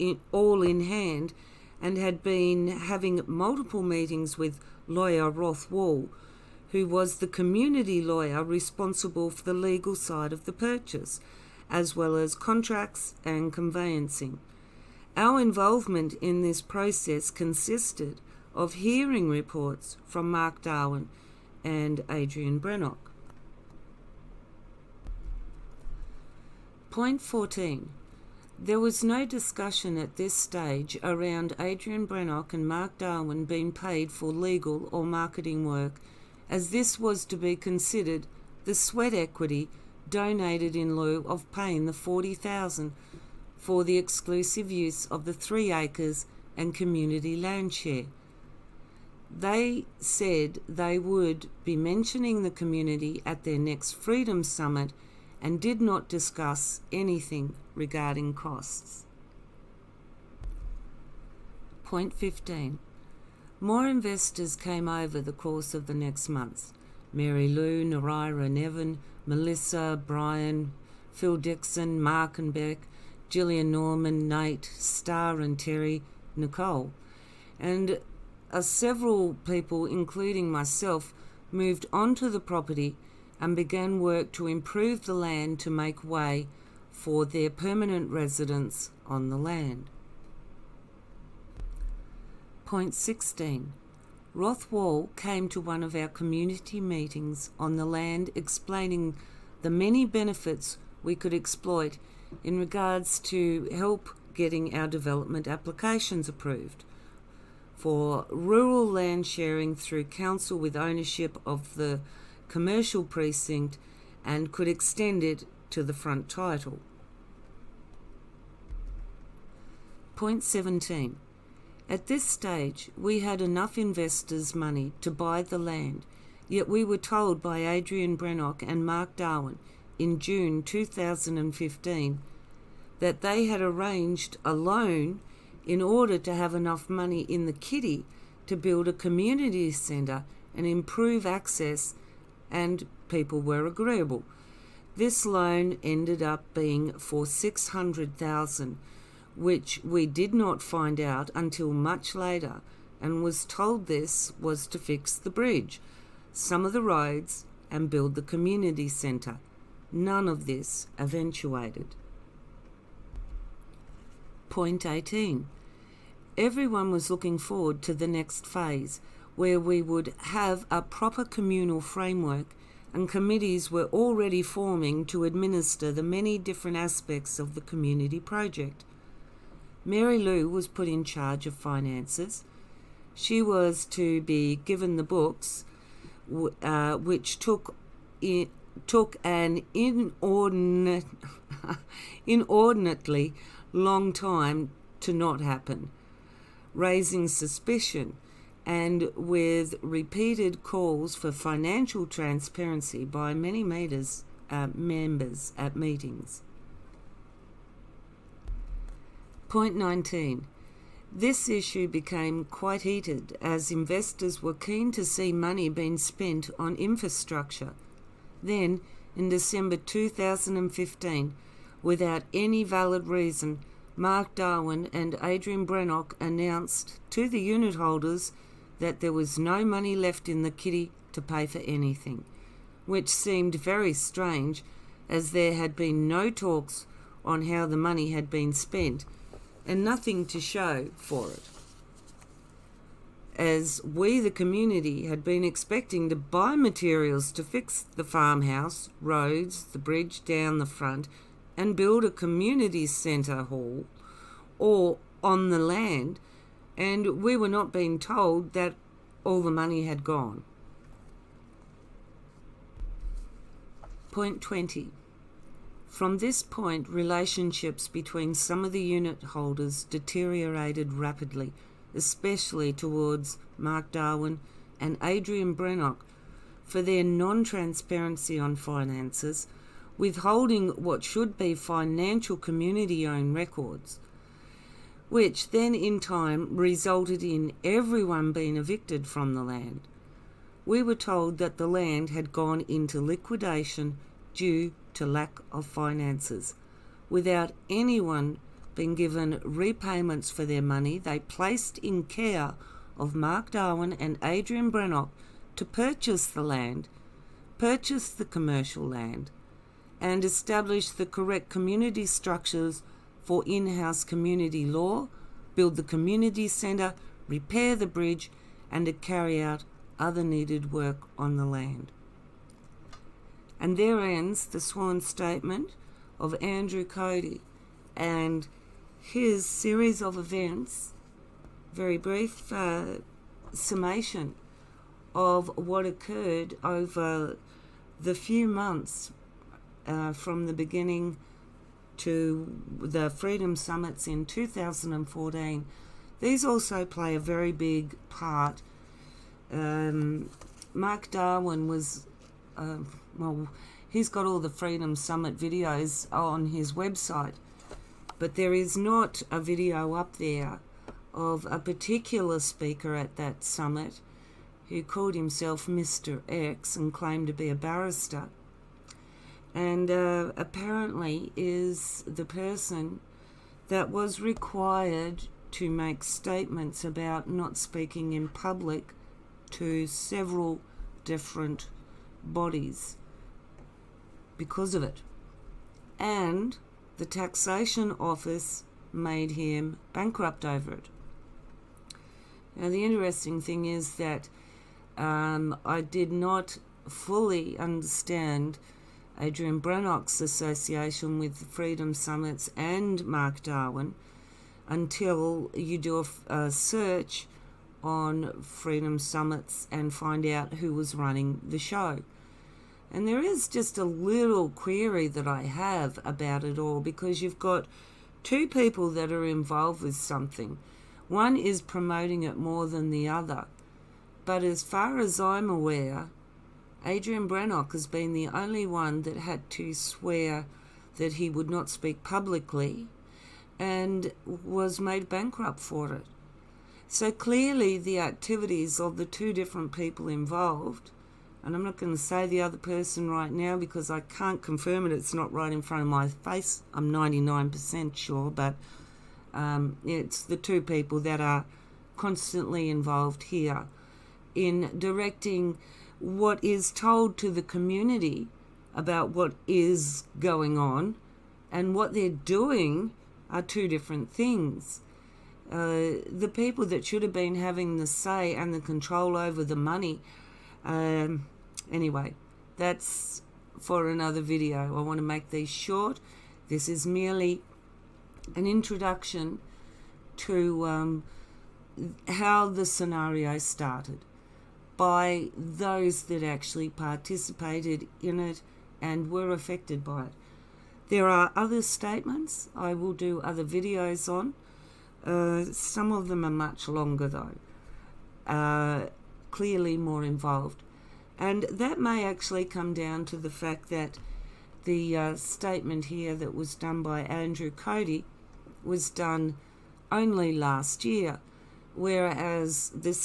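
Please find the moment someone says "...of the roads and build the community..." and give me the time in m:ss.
2:36.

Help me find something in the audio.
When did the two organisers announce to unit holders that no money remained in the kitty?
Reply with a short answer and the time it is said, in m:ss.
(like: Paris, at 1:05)
December 2015, at 3:39.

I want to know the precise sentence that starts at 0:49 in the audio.
They said they would be mentioning the community at their next Freedom Summit – and did not discuss anything regarding costs.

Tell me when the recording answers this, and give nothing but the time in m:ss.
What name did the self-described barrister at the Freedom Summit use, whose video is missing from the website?
6:05.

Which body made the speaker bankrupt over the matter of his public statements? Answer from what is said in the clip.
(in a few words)
the taxation office.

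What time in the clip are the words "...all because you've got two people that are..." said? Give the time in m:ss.
6:56.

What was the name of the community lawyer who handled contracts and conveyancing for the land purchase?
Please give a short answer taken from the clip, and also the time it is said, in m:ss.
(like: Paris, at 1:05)
Roth Wall, at 0:05.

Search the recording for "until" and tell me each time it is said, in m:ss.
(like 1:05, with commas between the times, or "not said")
2:31, 6:44.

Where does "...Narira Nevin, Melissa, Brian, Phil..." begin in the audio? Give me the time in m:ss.
1:07.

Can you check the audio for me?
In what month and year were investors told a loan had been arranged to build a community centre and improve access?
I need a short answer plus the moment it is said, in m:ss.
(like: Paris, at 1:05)
June 2015, at 2:10.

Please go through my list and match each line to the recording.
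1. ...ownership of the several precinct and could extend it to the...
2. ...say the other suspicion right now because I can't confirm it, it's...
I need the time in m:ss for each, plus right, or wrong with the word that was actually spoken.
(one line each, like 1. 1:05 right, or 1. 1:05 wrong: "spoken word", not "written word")
1. 1:50 wrong: "commercial", not "several"
2. 7:21 wrong: "person", not "suspicion".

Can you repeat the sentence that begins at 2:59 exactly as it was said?
Mary Lou was put in charge of finances.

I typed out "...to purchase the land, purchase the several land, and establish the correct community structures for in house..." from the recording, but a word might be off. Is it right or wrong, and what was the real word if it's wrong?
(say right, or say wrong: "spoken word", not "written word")
wrong: "commercial", not "several".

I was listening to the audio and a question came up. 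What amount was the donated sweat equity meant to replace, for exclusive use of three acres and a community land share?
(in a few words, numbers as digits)
40000.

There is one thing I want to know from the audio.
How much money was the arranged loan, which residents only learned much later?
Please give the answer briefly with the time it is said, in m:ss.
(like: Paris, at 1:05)
600,000, at 2:27.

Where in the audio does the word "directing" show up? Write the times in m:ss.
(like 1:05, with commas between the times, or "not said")
7:34.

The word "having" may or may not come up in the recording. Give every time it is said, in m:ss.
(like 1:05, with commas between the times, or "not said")
0:02, 7:47.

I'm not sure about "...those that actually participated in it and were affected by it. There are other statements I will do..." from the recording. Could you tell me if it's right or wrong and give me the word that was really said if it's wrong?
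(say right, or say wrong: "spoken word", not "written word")
right.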